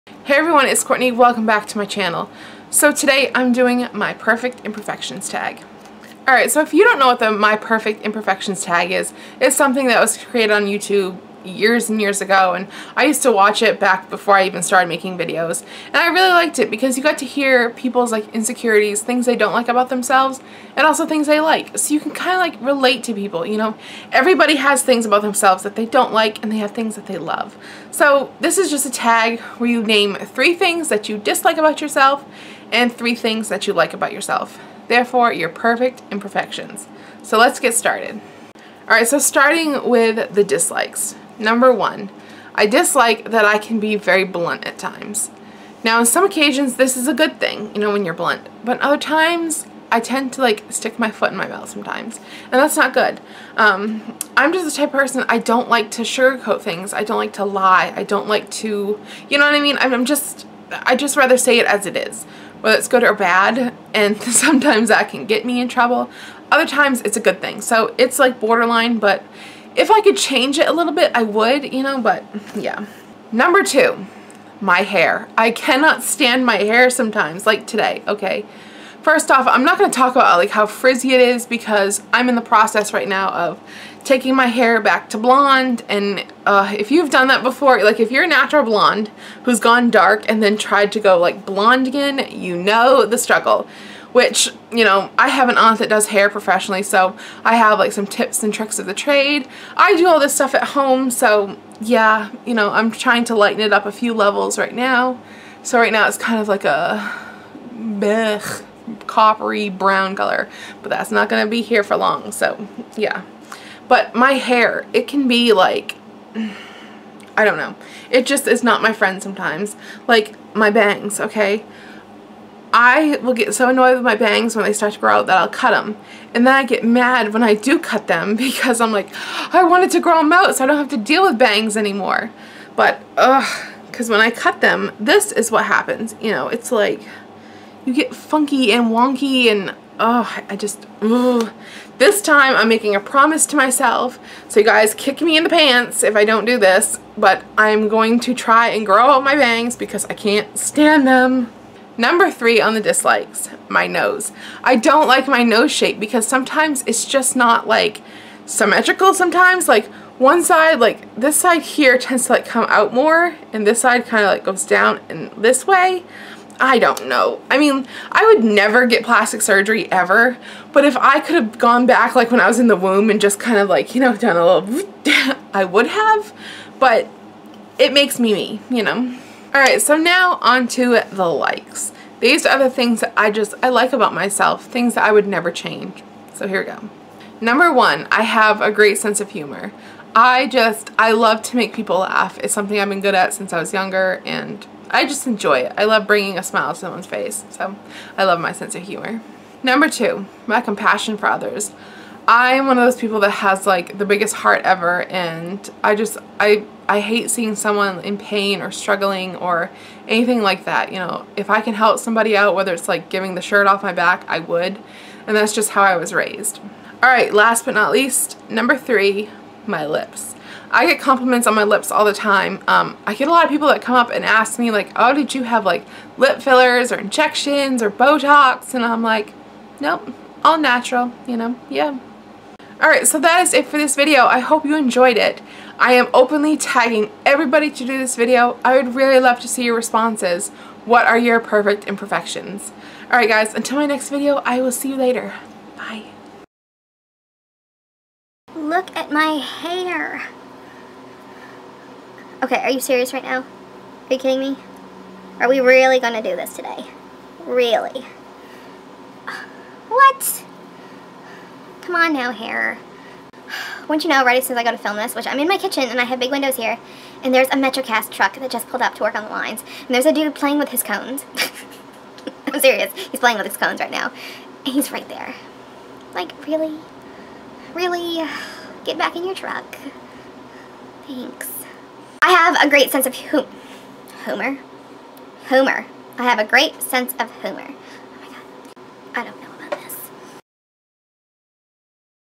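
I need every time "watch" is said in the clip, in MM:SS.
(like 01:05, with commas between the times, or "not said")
00:13.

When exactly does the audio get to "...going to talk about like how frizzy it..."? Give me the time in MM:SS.
01:19.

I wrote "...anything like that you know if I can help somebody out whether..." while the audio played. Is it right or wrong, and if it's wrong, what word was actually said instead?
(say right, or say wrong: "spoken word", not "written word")
right.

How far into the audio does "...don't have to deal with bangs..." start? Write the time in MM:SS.
02:10.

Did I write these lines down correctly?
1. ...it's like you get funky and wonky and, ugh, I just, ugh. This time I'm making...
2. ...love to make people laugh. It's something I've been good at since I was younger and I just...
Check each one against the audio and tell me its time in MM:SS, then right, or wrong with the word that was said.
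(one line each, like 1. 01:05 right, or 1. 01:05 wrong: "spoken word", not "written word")
1. 02:16 right
2. 03:11 right.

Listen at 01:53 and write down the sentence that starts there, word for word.
But my hair, it can be like, I don't know.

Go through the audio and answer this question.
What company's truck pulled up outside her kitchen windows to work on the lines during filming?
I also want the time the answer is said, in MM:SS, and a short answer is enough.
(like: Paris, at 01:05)
Metrocast, at 04:27.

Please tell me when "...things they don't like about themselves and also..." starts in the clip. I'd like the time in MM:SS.
00:19.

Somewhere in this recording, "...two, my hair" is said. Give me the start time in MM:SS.
01:13.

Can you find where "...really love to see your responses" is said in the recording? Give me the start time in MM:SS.
03:58.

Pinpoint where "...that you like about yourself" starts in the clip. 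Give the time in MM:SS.
00:33.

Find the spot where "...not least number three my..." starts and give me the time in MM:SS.
03:37.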